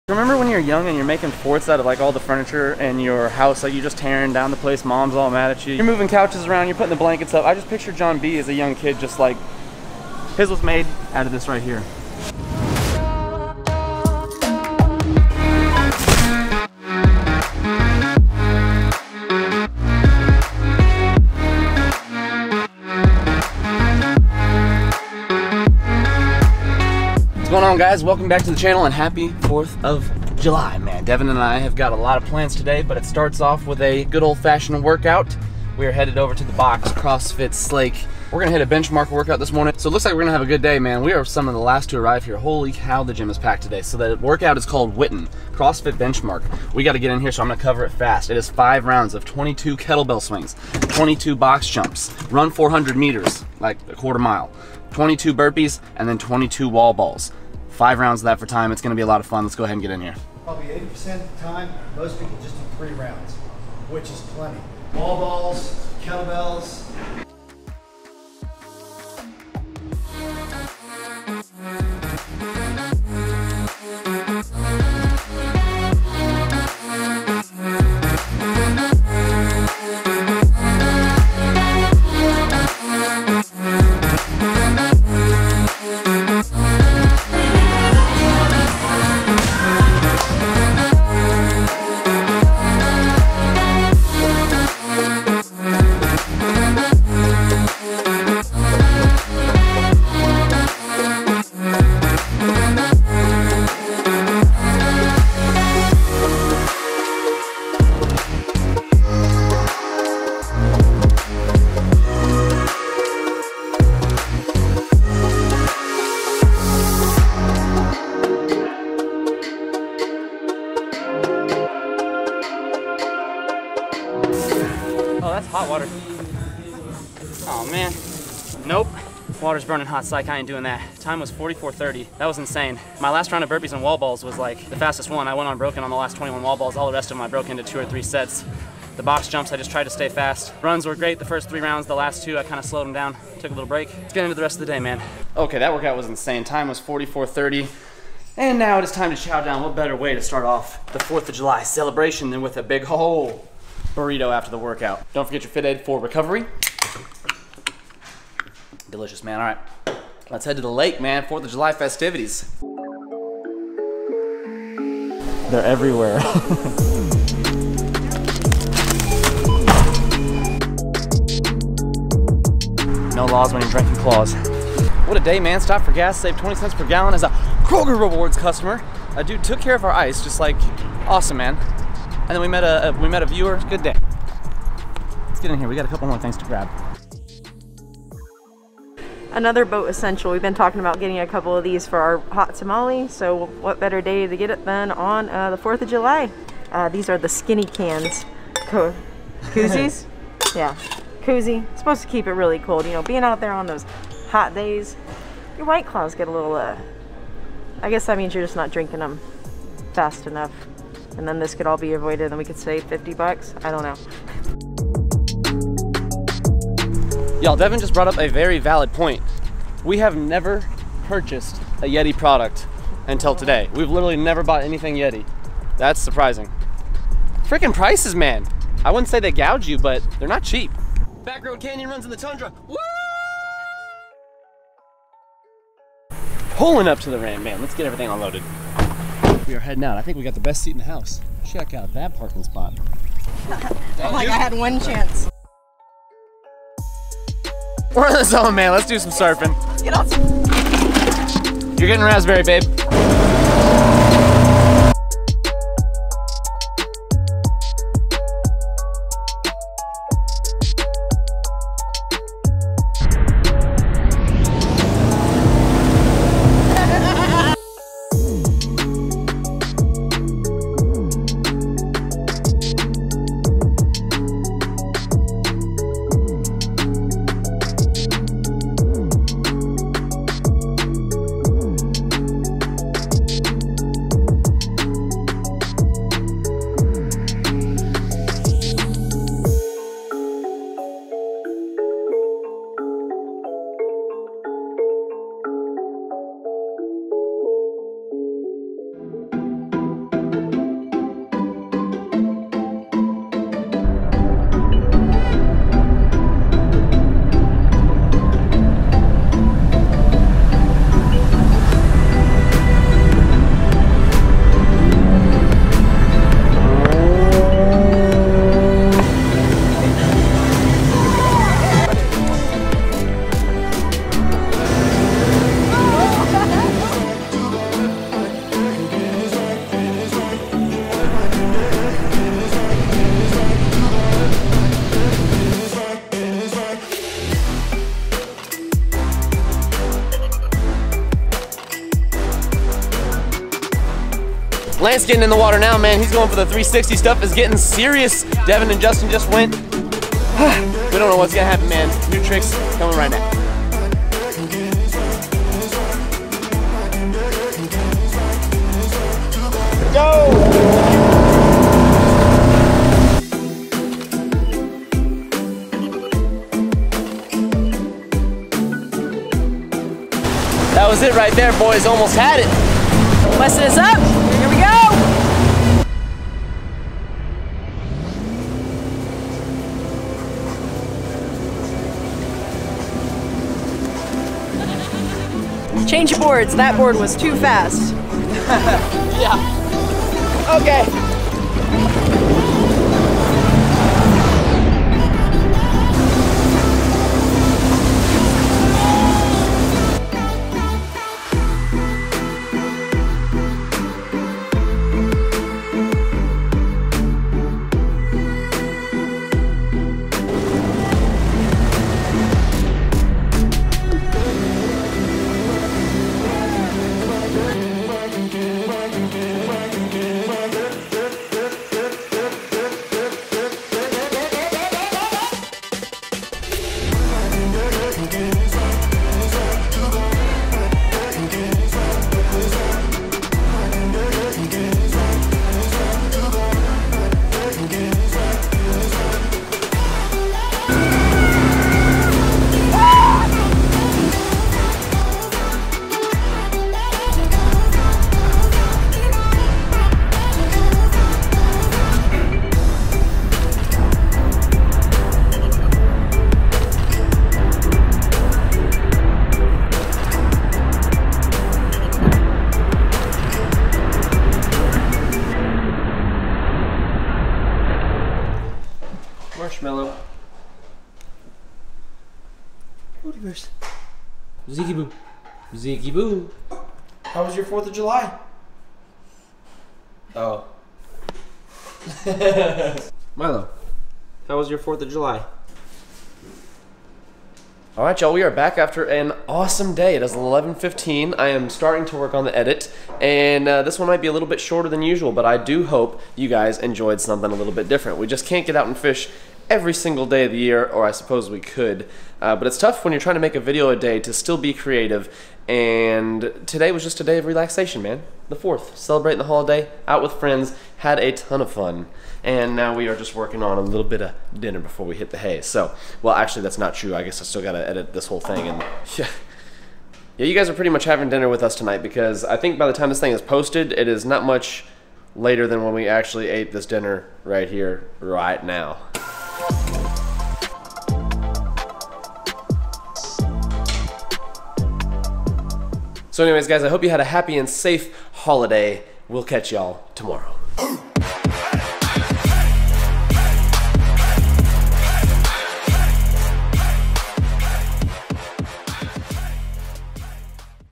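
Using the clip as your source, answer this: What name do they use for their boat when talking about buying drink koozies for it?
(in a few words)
Hot Tamale.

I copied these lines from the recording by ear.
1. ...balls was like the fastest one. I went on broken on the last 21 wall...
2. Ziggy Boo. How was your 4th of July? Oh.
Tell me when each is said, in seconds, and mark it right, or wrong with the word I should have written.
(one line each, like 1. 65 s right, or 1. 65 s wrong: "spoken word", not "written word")
1. 133 s right
2. 475 s right.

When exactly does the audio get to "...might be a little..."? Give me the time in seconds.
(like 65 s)
493 s.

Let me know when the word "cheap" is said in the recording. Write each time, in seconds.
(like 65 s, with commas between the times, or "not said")
230 s.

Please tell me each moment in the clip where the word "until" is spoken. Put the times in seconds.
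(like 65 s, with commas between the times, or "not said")
223 s.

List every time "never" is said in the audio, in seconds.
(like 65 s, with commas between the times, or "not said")
220 s, 224 s.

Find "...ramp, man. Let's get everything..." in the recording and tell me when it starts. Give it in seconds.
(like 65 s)
237 s.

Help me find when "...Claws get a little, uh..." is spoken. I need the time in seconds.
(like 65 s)
205 s.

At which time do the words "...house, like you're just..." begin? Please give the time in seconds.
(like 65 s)
3 s.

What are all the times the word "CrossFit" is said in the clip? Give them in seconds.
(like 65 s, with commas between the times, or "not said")
36 s, 45 s.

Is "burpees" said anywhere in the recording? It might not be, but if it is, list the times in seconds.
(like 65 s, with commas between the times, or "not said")
55 s, 133 s.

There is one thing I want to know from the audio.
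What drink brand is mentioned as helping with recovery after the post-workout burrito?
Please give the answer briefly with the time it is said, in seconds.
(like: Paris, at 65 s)
FitAid, at 155 s.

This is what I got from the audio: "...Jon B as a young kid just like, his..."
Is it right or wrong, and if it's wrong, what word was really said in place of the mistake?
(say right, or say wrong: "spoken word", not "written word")
right.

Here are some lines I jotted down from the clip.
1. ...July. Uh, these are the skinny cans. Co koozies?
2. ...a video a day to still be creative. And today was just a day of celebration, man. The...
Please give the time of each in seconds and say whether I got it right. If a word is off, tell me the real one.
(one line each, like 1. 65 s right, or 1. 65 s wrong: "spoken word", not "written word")
1. 195 s right
2. 503 s wrong: "relaxation", not "celebration".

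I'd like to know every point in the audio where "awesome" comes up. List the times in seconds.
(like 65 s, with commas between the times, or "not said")
181 s, 489 s.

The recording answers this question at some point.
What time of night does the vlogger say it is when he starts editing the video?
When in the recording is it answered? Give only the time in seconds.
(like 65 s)
490 s.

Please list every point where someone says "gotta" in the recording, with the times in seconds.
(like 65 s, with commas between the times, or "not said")
46 s, 517 s.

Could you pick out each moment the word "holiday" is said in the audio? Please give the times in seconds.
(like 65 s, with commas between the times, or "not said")
509 s, 538 s.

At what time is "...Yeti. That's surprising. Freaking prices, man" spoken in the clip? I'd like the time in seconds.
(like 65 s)
224 s.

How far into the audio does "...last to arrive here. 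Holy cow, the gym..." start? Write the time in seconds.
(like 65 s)
41 s.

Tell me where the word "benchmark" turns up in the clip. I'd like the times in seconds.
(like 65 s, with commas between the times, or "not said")
38 s, 45 s.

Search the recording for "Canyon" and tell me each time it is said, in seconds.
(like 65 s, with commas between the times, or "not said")
231 s.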